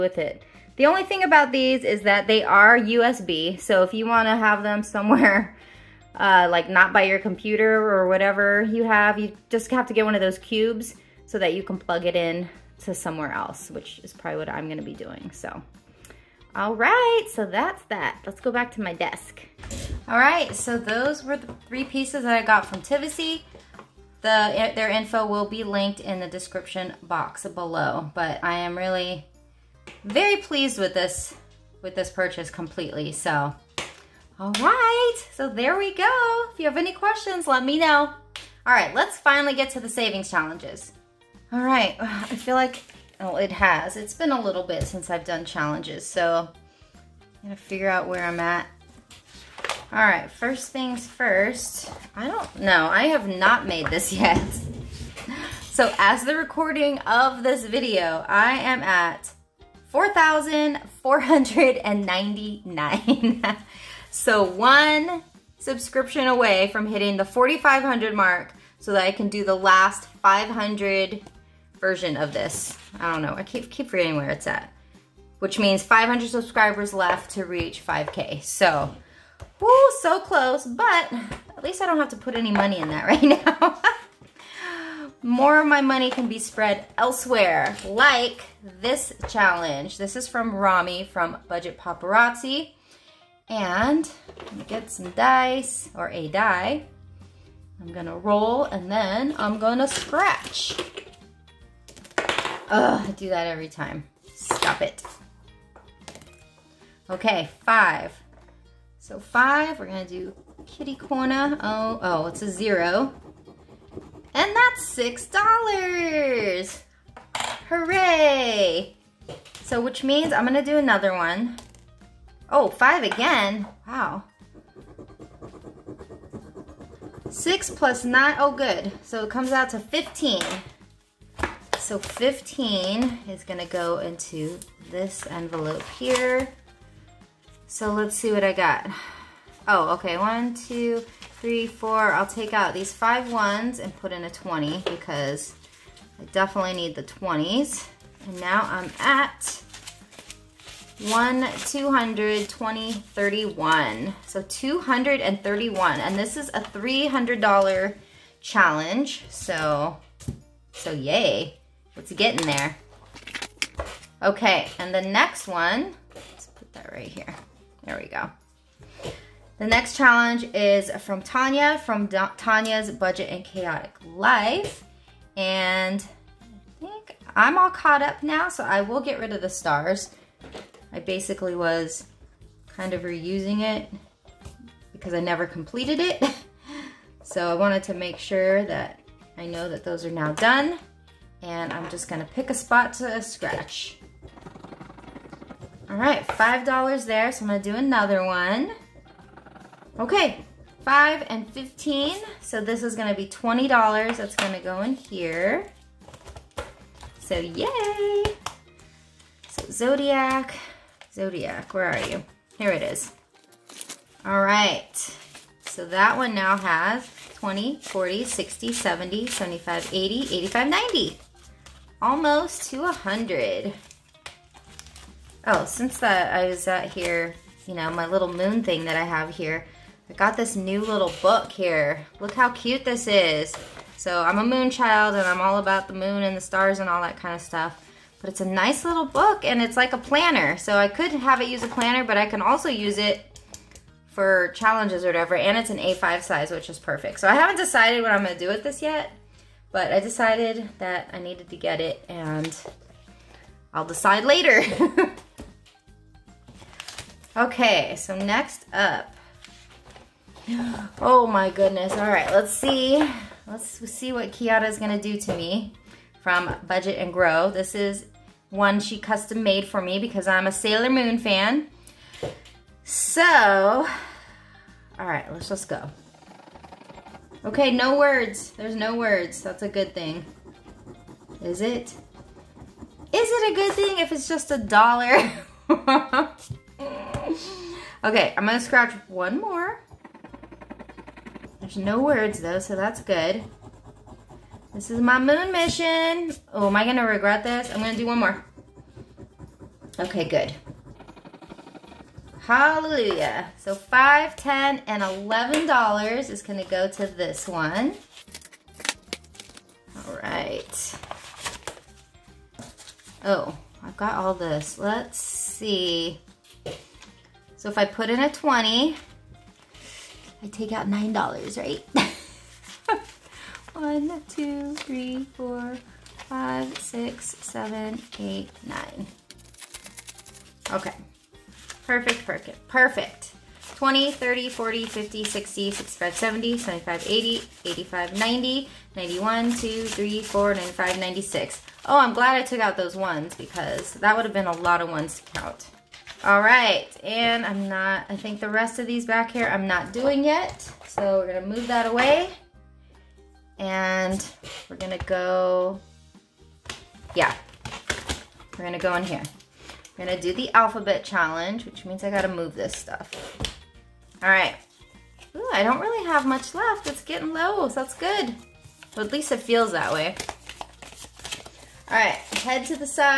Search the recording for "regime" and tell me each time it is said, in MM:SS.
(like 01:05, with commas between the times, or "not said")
not said.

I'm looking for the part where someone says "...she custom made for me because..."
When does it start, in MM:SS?
04:28.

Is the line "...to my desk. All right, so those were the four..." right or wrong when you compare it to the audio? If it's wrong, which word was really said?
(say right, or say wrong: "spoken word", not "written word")
wrong: "three", not "four".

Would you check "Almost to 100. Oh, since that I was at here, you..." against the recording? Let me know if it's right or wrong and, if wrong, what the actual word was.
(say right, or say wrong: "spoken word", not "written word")
right.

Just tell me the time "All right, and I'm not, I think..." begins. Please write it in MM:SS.
05:46.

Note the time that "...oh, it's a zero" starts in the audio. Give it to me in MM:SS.
01:52.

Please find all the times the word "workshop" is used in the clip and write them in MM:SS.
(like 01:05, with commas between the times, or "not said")
not said.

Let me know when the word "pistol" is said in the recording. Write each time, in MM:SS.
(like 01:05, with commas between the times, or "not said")
not said.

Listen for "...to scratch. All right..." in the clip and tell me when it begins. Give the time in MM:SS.
03:12.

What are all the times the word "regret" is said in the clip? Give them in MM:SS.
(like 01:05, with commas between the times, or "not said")
04:57.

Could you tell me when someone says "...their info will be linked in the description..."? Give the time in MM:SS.
00:24.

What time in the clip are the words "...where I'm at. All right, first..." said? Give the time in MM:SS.
00:48.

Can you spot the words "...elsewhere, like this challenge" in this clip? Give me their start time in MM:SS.
01:26.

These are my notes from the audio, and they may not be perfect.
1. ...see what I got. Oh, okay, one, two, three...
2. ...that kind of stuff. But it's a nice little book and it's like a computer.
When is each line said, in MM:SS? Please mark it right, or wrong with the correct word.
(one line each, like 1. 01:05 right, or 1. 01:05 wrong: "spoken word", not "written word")
1. 02:18 right
2. 03:57 wrong: "planner", not "computer".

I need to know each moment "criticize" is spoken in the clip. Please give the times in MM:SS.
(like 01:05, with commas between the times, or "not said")
not said.